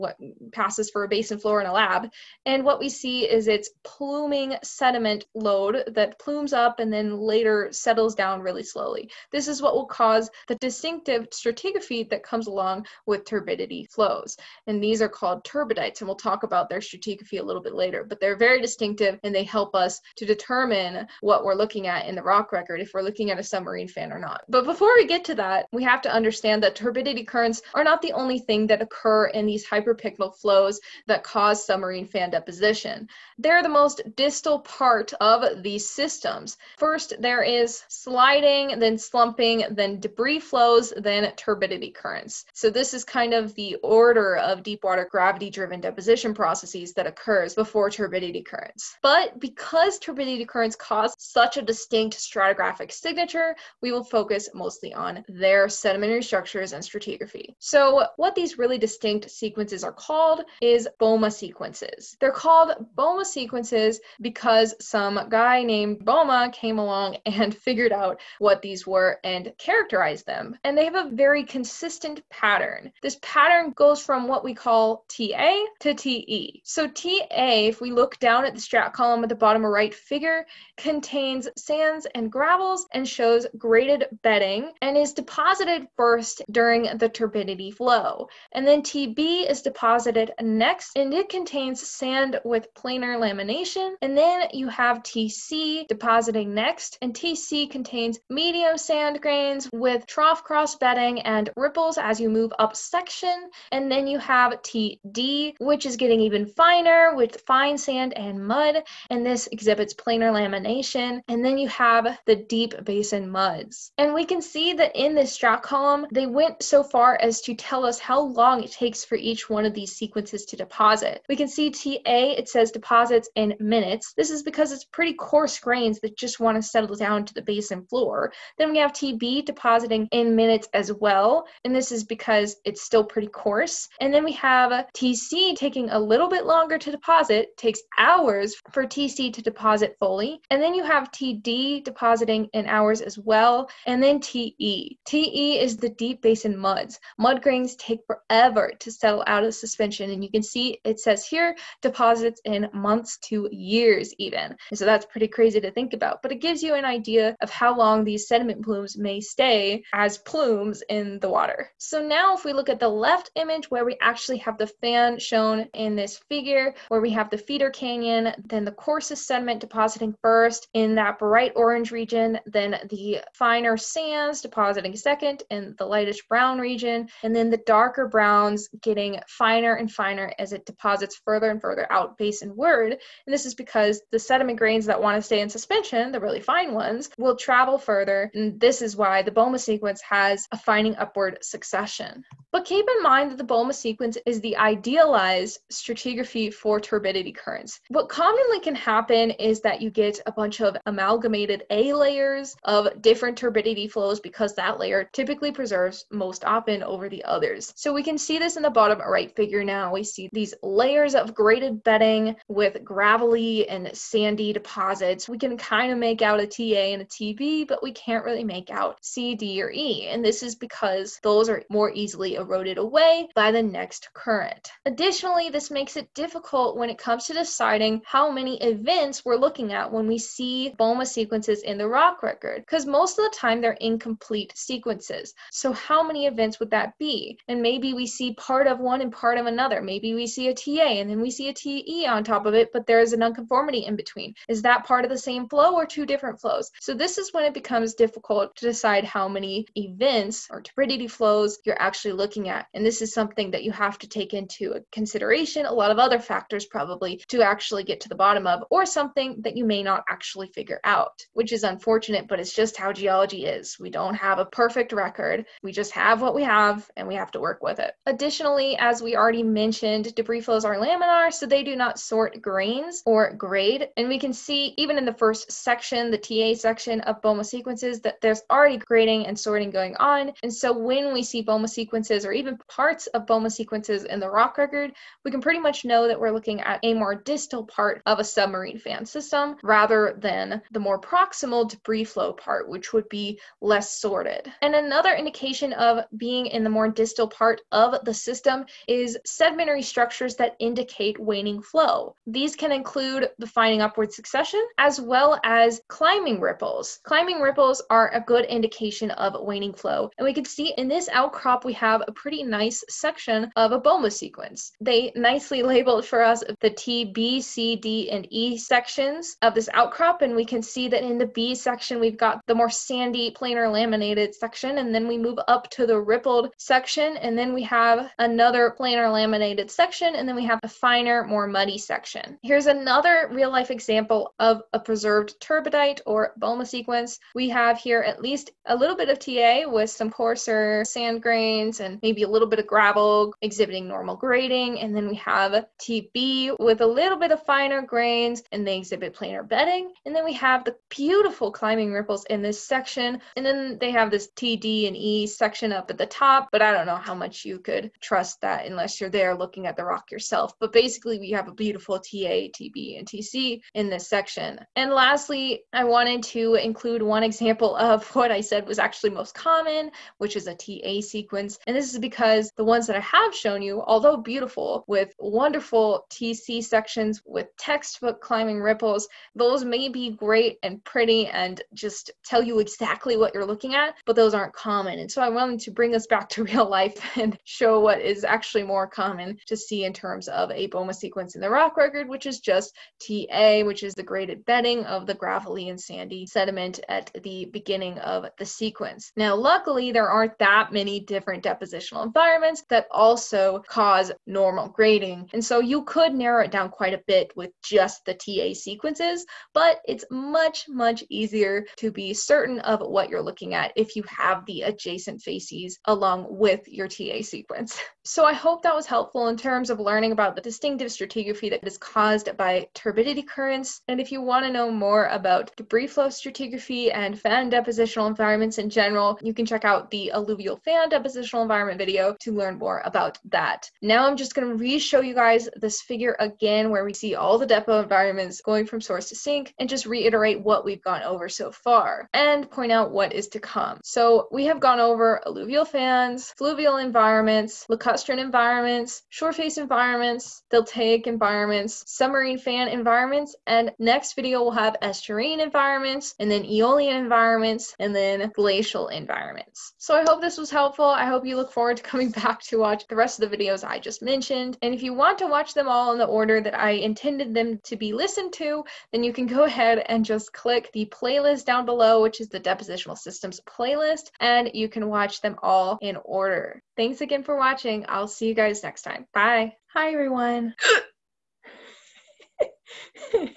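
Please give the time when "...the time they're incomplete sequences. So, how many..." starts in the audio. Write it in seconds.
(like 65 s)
233 s.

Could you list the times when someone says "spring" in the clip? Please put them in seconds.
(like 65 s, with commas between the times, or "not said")
not said.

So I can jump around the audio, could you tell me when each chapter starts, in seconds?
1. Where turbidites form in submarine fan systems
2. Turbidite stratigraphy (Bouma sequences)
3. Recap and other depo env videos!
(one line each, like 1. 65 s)
1. 23 s
2. 56 s
3. 416 s.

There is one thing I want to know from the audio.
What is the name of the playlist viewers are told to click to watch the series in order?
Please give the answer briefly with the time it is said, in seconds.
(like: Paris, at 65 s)
Depositional Systems, at 472 s.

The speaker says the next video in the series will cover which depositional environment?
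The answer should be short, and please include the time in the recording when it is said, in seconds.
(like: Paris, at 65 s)
Estuarine, at 454 s.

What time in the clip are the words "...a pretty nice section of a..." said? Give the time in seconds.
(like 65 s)
312 s.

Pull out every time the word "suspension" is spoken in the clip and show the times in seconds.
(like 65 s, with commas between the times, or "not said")
149 s, 185 s.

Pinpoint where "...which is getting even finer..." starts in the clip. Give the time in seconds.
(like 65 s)
105 s.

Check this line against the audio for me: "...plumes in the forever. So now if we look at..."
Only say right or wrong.
wrong.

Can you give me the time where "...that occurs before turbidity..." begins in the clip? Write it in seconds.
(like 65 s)
46 s.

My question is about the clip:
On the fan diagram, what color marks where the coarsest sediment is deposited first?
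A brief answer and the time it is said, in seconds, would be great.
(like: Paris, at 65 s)
Bright orange, at 171 s.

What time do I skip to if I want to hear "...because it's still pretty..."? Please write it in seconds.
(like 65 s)
132 s.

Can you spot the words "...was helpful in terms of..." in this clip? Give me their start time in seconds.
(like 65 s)
418 s.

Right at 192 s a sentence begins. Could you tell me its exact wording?
But keep in mind that the Bouma sequence is the idealized stratigraphy for turbidity currents.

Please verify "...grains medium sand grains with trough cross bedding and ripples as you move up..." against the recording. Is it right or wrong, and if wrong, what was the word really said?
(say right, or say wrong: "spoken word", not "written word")
wrong: "contains", not "grains".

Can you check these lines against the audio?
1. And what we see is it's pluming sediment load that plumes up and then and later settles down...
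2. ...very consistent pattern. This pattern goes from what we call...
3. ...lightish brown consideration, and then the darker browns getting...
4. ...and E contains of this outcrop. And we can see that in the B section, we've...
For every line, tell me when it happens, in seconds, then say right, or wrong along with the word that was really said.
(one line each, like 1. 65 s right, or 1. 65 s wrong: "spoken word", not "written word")
1. 2 s right
2. 71 s right
3. 175 s wrong: "region", not "consideration"
4. 318 s wrong: "sections", not "contains".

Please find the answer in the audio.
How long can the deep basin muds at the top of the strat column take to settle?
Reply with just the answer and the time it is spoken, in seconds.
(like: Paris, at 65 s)
Months to years, at 152 s.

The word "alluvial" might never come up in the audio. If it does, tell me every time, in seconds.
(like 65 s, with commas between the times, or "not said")
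430 s, 445 s.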